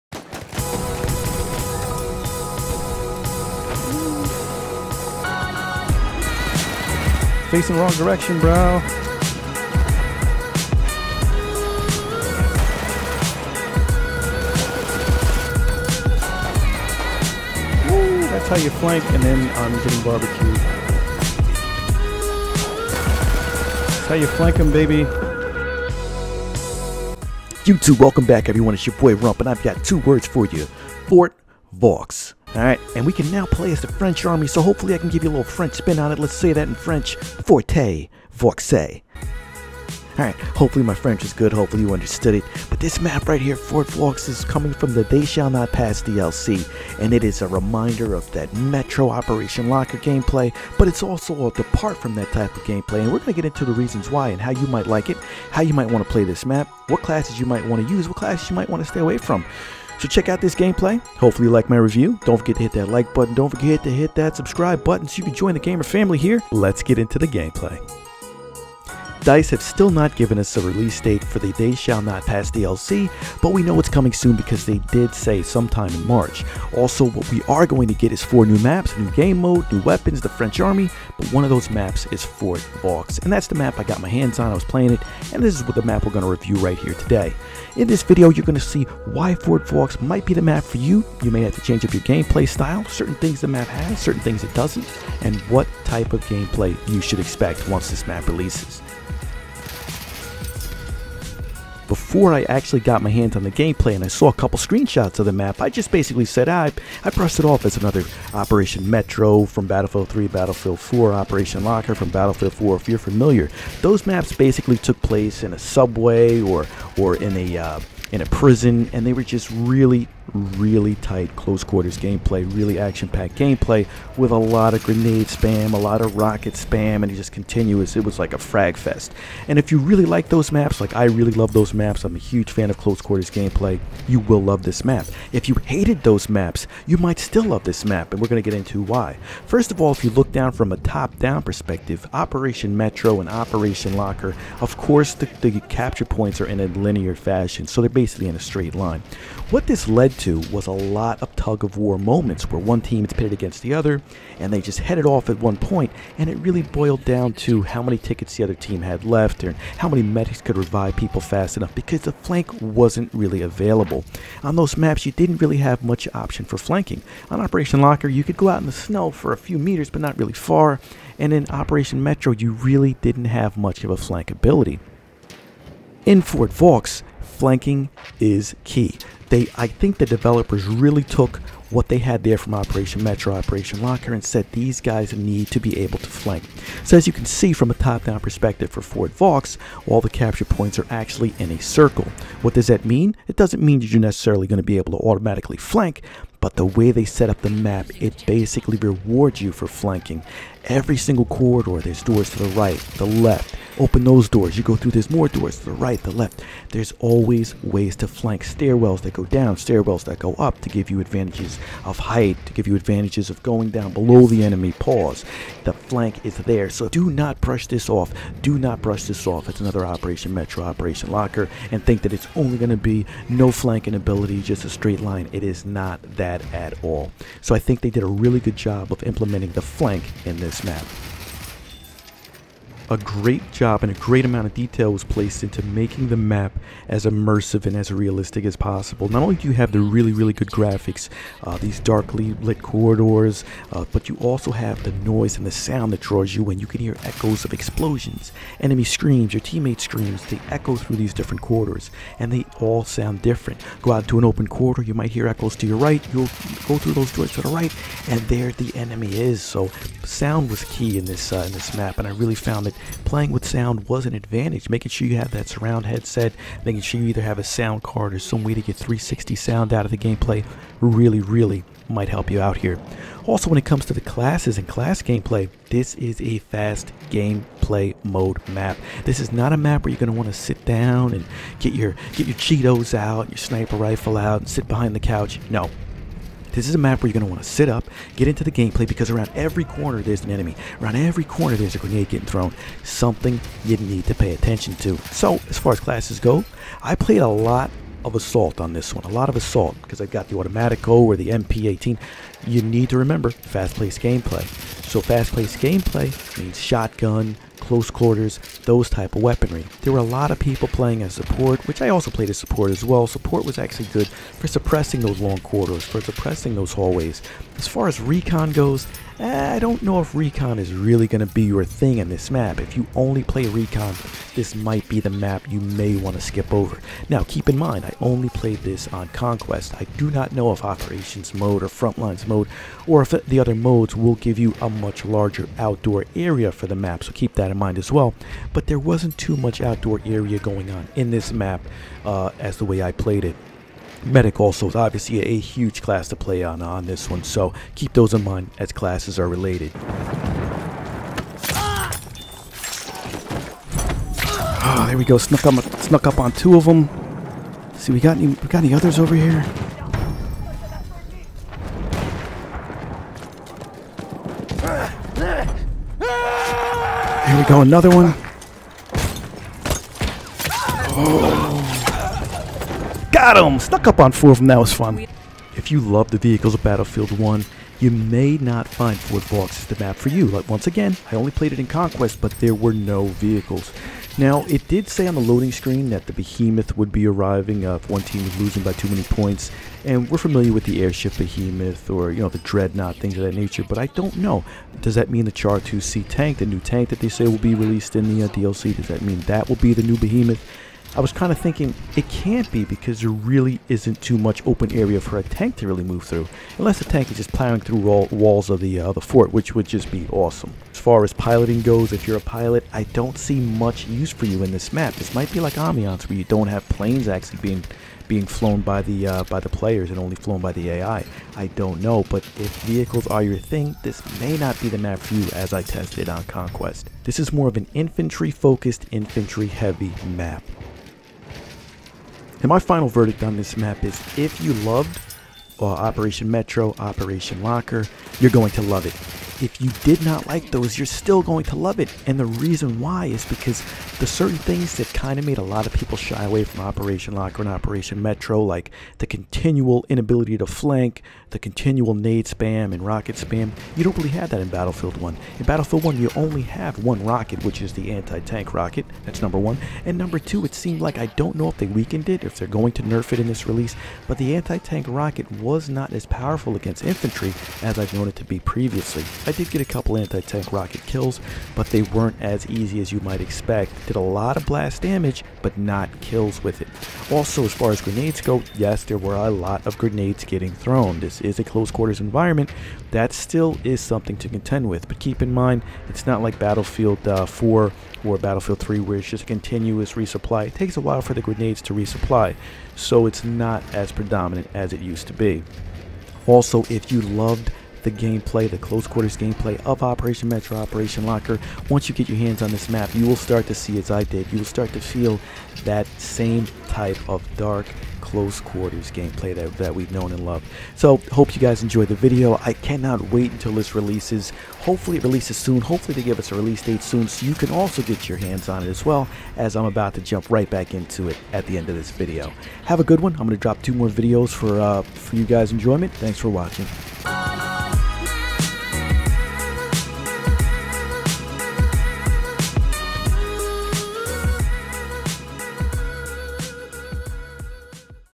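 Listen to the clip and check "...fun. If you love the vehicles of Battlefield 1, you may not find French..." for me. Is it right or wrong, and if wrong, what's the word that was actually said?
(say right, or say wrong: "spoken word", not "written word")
wrong: "Fort", not "French".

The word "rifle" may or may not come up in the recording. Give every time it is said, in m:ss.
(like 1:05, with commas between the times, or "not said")
4:43.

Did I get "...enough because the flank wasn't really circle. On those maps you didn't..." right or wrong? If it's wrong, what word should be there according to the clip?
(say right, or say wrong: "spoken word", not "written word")
wrong: "available", not "circle".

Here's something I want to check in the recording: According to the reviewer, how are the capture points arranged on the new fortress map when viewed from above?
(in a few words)
In a circle.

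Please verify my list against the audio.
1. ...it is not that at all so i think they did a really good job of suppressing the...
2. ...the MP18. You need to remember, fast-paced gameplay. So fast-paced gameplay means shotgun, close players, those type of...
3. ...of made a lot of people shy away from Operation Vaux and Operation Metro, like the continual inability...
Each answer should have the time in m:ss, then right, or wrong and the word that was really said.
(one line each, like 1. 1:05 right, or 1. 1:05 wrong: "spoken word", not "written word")
1. 3:45 wrong: "implementing", not "suppressing"
2. 5:01 wrong: "quarters", not "players"
3. 7:25 wrong: "Locker", not "Vaux".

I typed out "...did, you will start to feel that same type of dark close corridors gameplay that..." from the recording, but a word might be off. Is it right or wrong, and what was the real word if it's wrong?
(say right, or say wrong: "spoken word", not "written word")
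wrong: "quarters", not "corridors".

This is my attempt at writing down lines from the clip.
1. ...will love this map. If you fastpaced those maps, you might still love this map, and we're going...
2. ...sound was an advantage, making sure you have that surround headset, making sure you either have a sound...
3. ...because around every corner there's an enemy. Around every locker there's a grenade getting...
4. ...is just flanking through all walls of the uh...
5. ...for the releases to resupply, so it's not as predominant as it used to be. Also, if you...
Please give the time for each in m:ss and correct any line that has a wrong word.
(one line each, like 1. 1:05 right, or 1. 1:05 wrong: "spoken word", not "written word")
1. 2:14 wrong: "hated", not "fastpaced"
2. 4:23 right
3. 4:48 wrong: "corner", not "locker"
4. 6:47 wrong: "plowing", not "flanking"
5. 8:11 wrong: "grenades", not "releases".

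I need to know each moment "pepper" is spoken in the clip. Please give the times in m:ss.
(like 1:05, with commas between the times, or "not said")
not said.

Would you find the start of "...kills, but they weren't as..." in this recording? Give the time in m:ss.
7:50.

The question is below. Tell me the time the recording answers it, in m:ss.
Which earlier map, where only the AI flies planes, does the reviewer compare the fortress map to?
6:55.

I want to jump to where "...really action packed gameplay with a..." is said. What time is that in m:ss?
2:02.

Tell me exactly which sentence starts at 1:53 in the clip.
Those maps basically took place in a subway or, or in a...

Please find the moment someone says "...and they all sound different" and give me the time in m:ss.
4:12.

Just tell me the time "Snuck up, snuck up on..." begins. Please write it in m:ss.
5:55.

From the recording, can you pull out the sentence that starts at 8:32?
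I cannot wait until this releases.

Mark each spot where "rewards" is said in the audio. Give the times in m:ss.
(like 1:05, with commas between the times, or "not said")
3:18.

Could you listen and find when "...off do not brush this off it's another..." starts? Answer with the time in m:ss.
3:37.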